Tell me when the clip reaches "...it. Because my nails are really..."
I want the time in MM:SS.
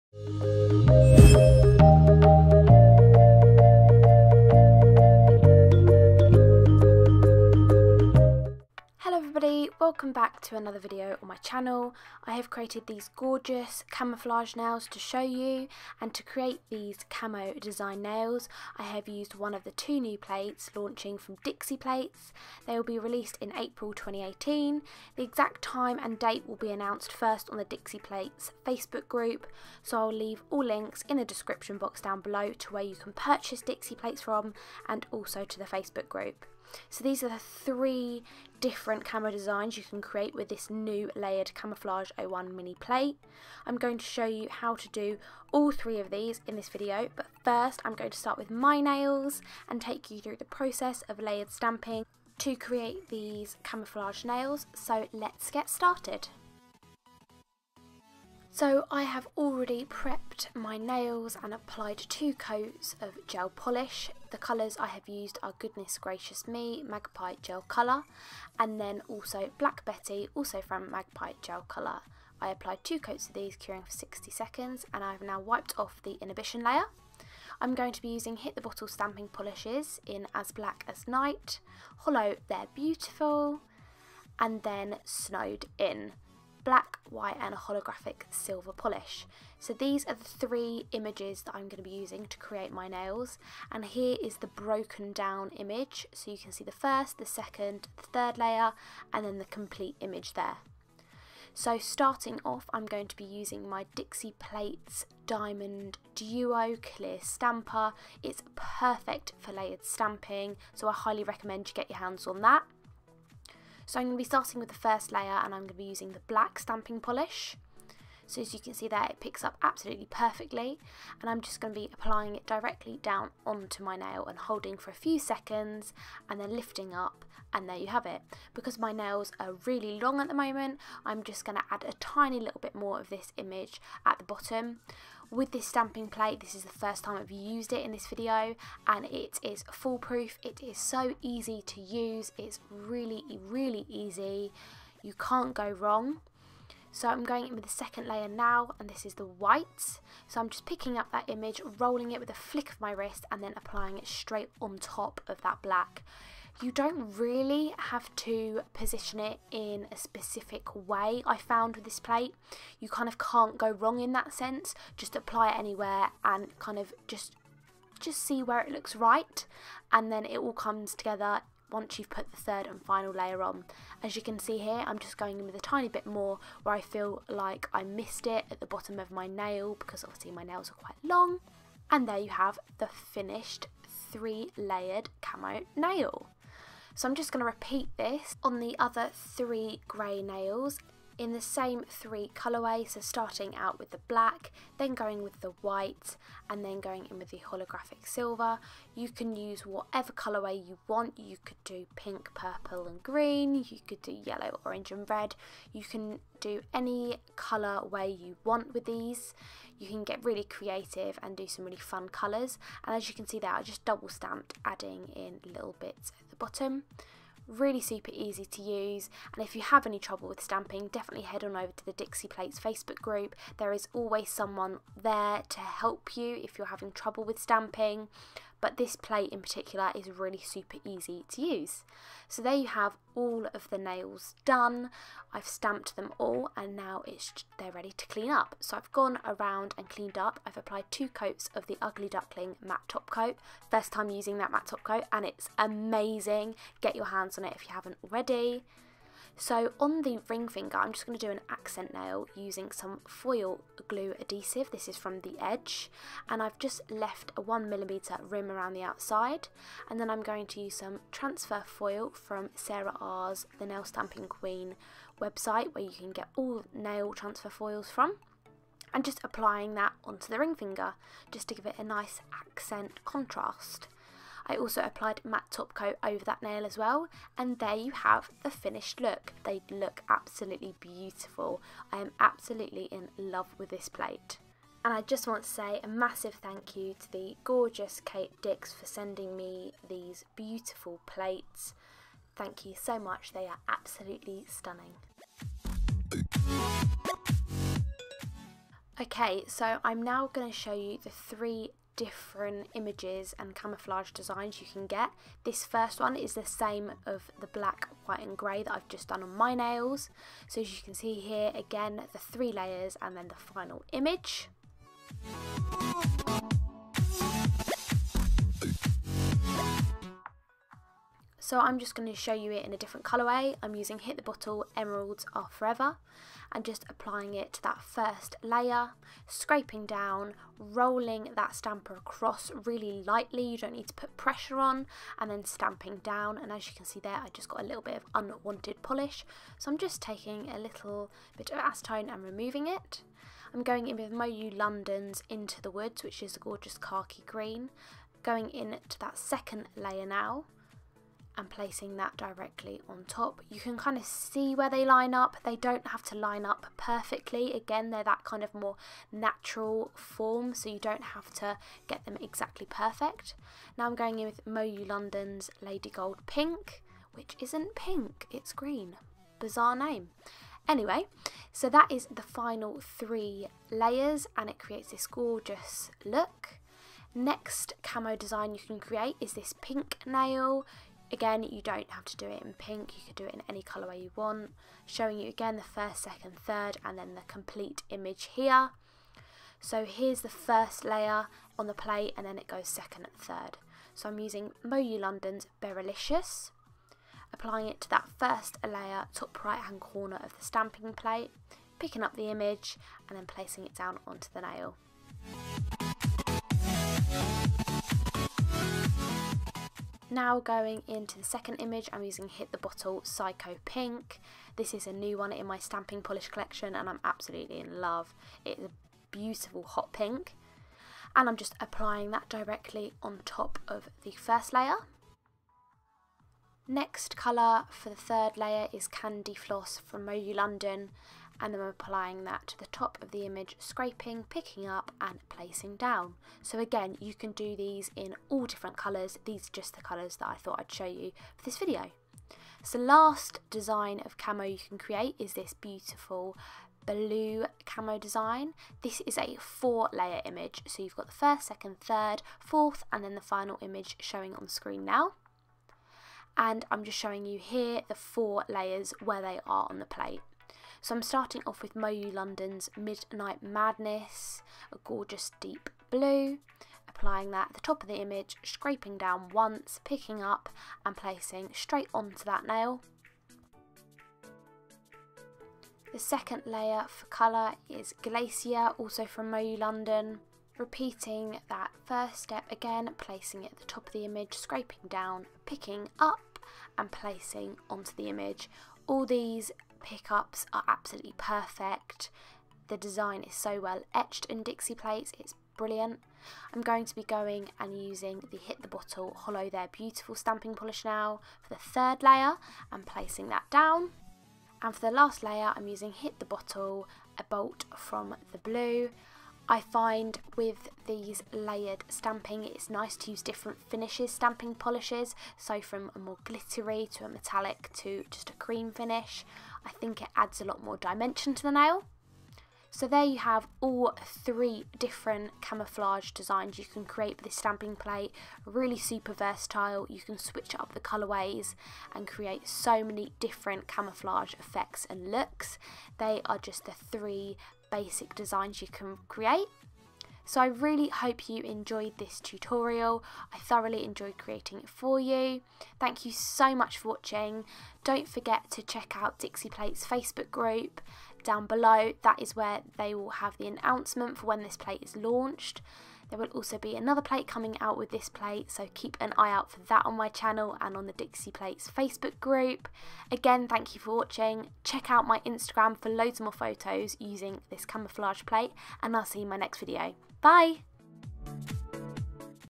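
02:08.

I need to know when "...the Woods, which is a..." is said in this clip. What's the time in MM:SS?
05:45.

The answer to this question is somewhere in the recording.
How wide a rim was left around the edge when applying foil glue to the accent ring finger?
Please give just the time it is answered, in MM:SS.
04:17.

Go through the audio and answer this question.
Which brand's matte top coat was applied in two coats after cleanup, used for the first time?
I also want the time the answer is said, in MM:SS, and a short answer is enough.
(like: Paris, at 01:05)
Ugly Duckling, at 04:01.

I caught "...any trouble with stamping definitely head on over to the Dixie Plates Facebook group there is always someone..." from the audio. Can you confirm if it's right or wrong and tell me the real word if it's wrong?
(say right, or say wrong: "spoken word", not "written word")
right.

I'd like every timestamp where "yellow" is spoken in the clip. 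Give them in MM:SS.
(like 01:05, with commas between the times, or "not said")
03:24.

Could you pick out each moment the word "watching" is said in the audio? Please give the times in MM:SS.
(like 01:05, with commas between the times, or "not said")
09:06, 09:23.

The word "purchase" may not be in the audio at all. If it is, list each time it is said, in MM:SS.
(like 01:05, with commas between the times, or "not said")
00:33.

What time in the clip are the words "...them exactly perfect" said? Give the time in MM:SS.
06:02.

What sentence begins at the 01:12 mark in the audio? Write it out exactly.
I applied two coats of these, curing for 60 seconds, and I've now wiped off the inhibition layer.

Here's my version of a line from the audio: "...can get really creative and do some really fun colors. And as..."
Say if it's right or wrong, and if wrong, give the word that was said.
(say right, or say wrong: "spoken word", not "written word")
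right.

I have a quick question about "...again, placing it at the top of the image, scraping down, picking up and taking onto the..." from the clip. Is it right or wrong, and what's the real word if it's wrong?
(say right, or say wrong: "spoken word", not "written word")
wrong: "placing", not "taking".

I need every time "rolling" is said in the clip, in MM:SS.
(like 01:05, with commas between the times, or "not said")
02:31, 05:30.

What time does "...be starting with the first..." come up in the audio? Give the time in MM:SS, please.
01:54.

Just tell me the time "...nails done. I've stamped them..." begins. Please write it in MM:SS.
03:53.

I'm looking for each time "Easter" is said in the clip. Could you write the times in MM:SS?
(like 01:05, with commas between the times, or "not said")
not said.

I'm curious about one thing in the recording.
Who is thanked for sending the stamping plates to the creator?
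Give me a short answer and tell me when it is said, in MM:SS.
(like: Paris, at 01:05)
Kate Dix, at 04:48.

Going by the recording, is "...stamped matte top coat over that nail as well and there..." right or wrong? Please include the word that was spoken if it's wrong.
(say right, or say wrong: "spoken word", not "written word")
wrong: "applied", not "stamped".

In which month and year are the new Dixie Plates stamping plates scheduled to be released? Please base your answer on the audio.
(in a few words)
April 2018.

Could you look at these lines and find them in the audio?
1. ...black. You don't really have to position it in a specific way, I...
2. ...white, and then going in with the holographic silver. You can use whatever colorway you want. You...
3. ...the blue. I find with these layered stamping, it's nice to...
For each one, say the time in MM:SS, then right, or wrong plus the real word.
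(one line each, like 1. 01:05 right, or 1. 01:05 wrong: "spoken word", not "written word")
1. 02:35 right
2. 03:15 right
3. 08:28 right.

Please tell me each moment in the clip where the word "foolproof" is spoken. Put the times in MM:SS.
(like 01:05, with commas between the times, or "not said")
02:19.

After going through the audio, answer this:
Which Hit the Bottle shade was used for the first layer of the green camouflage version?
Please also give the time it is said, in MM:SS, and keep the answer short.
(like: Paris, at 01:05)
Emeralds Are Forever, at 05:24.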